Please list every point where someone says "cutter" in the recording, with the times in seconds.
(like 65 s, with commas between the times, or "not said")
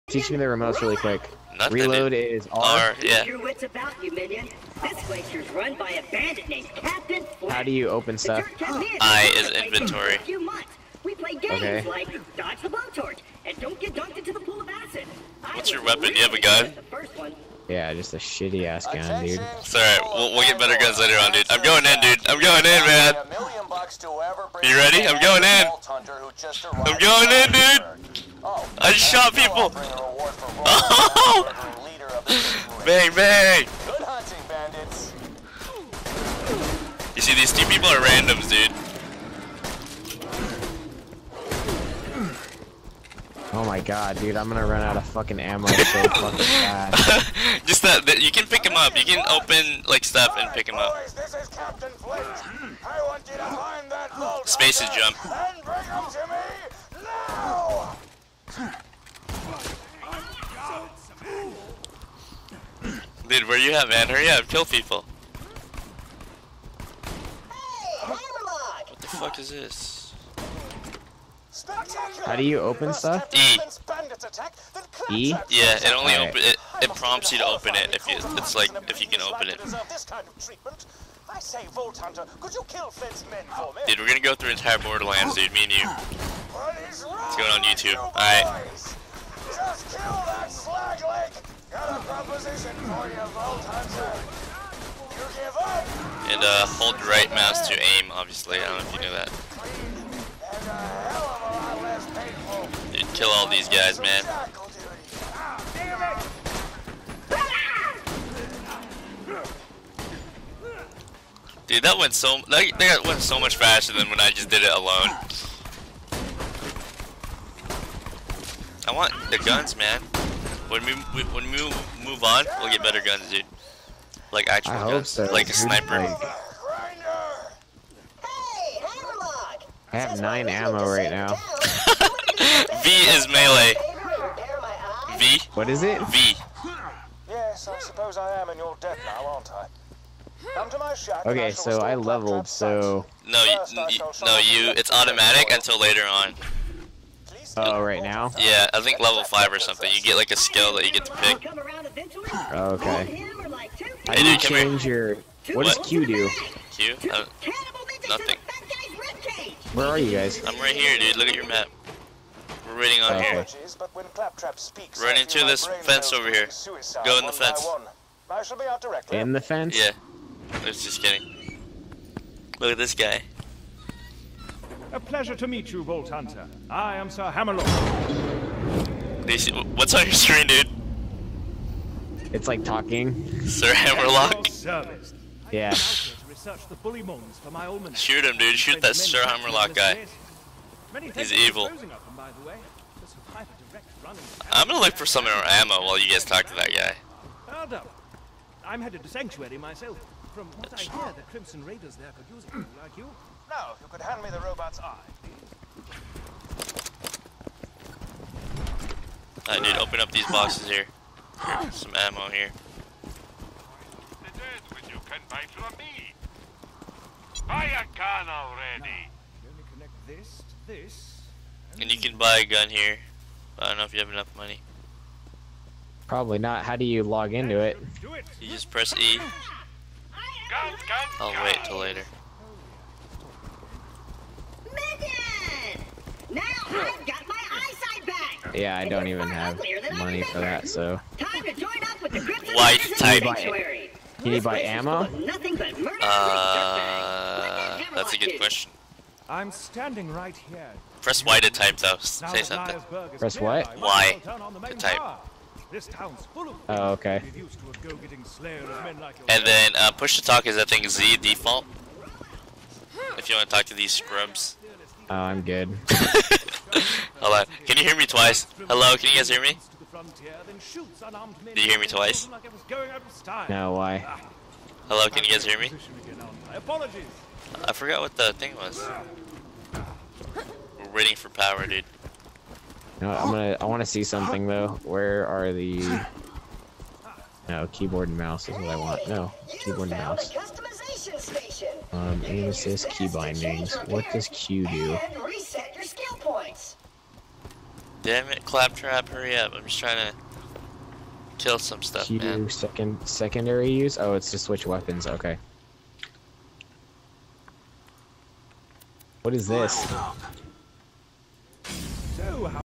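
not said.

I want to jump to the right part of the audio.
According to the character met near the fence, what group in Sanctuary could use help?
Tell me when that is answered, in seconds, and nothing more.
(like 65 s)
201 s.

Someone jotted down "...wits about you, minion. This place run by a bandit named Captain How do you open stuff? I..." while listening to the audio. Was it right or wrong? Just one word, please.
right.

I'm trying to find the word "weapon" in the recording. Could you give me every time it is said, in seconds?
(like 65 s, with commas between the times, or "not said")
15 s, 304 s.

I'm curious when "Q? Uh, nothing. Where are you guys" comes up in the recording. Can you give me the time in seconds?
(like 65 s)
156 s.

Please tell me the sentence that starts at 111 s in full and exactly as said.
Dude, that went so that, that went so much faster than when I just did it alone.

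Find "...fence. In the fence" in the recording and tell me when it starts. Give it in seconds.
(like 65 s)
167 s.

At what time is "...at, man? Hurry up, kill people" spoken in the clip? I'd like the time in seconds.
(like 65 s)
63 s.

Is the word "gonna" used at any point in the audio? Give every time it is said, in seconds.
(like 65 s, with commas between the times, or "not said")
44 s, 84 s, 194 s, 283 s.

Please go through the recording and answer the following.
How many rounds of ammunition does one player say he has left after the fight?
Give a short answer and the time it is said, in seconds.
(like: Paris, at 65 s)
9, at 130 s.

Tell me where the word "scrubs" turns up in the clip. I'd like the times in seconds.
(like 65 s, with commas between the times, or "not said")
263 s.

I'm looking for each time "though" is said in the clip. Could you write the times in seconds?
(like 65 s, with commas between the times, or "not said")
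251 s, 284 s.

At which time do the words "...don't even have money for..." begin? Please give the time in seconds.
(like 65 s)
238 s.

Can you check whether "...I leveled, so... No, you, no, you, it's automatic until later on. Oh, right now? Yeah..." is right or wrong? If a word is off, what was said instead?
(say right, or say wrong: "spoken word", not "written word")
right.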